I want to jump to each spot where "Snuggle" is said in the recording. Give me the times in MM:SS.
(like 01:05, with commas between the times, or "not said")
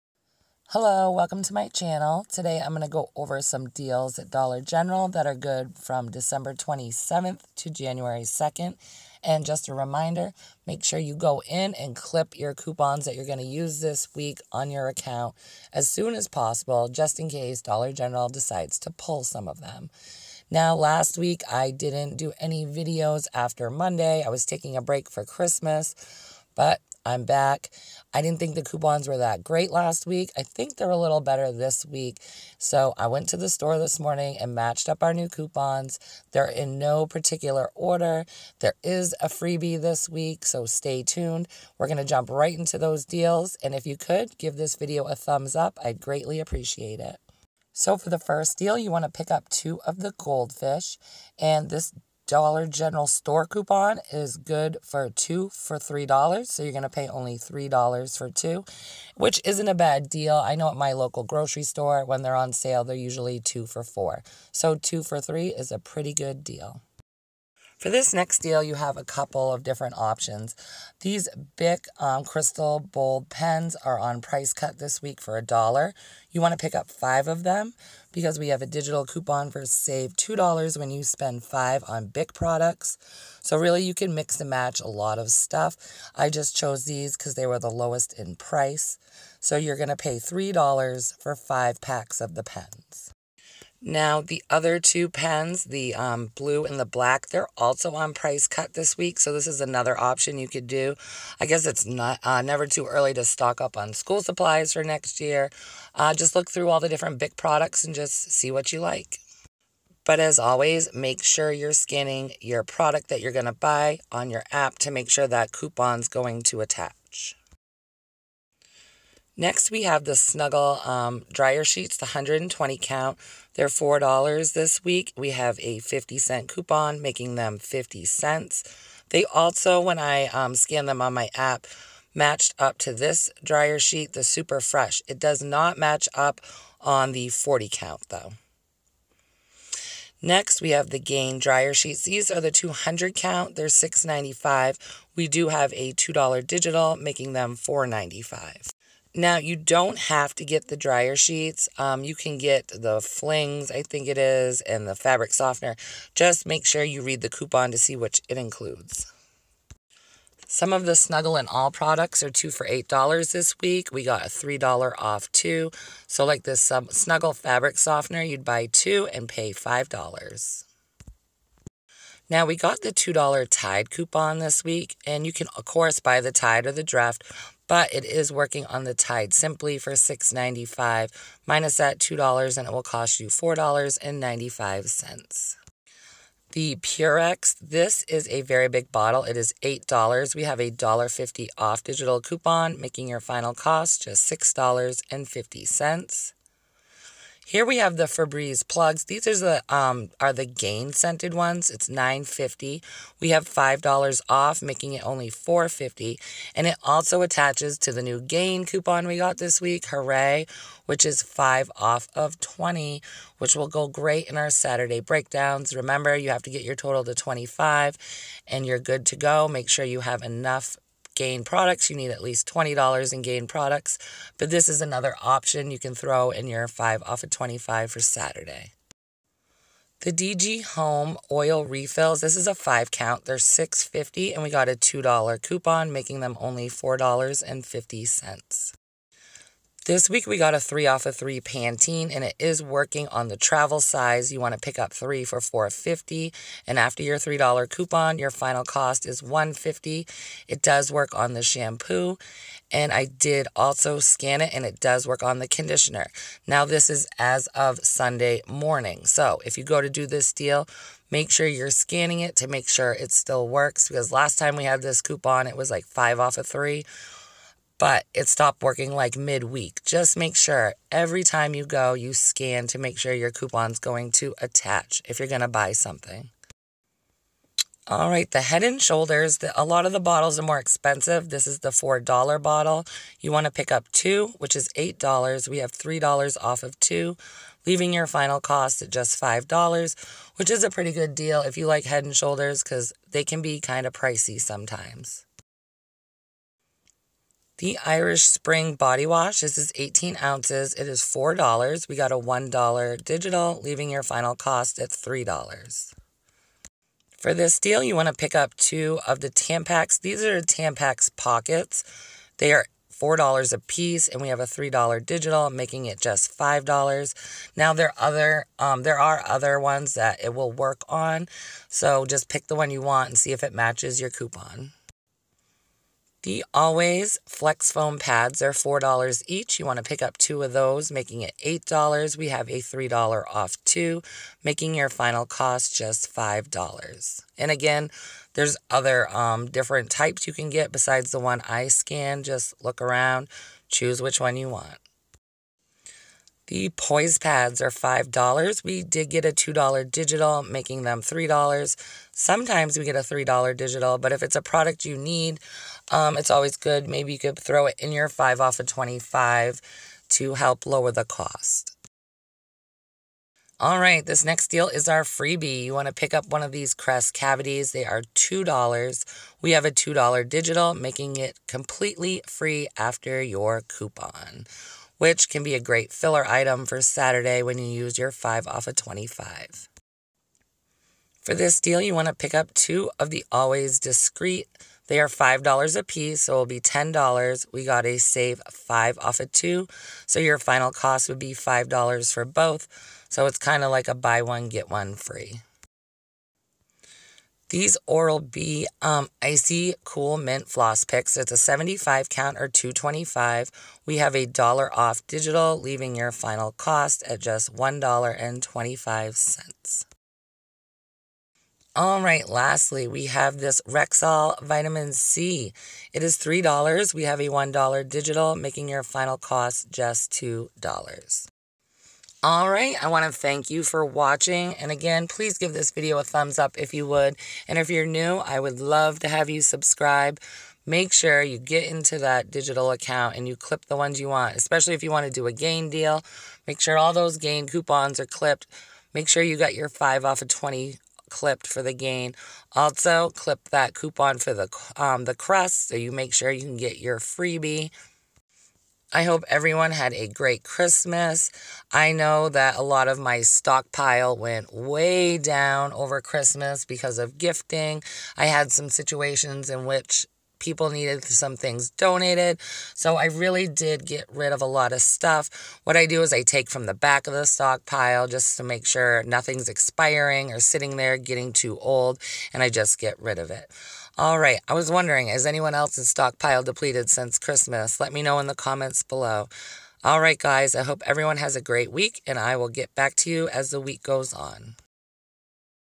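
02:00, 02:40, 02:46.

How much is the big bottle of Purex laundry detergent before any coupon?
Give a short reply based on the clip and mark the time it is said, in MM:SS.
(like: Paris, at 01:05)
$8, at 03:09.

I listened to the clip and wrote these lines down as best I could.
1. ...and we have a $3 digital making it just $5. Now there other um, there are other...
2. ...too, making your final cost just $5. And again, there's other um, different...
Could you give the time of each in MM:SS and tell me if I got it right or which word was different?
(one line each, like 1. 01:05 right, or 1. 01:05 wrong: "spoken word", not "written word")
1. 05:14 right
2. 05:33 right.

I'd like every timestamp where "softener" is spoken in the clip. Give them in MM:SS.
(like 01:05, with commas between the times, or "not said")
02:35, 02:47.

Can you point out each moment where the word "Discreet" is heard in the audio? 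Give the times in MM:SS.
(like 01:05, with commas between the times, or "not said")
06:23.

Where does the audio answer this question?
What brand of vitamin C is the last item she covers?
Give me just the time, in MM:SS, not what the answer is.
06:53.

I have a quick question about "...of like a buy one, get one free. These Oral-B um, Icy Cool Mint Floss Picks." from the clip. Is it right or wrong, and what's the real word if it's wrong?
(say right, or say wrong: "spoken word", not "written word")
right.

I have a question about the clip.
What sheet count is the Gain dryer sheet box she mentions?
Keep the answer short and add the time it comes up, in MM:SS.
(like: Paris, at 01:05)
200, at 02:22.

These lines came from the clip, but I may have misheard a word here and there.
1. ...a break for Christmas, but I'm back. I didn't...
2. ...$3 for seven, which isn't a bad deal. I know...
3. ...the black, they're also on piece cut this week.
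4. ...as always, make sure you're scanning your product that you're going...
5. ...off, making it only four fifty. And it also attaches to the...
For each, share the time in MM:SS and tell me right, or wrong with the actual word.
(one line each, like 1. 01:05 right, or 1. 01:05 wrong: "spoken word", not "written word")
1. 00:24 right
2. 00:57 wrong: "two", not "seven"
3. 01:36 wrong: "price", not "piece"
4. 01:50 right
5. 03:24 right.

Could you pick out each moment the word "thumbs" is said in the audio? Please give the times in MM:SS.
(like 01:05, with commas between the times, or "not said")
00:45, 07:06.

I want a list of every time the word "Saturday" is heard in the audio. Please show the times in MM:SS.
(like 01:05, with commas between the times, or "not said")
03:34, 03:47, 06:16.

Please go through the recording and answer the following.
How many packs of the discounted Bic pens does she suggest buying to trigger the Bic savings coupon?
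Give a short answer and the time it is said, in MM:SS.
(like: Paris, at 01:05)
5, at 01:16.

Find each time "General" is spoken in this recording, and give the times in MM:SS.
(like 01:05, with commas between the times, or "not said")
00:04, 00:17, 00:52.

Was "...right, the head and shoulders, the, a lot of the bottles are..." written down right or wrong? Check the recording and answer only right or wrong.
right.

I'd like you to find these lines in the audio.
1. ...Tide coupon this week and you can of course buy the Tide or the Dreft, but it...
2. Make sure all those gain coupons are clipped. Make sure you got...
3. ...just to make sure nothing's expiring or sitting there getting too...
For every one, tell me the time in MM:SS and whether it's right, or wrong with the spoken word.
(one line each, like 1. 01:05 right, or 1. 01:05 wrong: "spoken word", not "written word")
1. 02:53 right
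2. 07:16 right
3. 07:48 right.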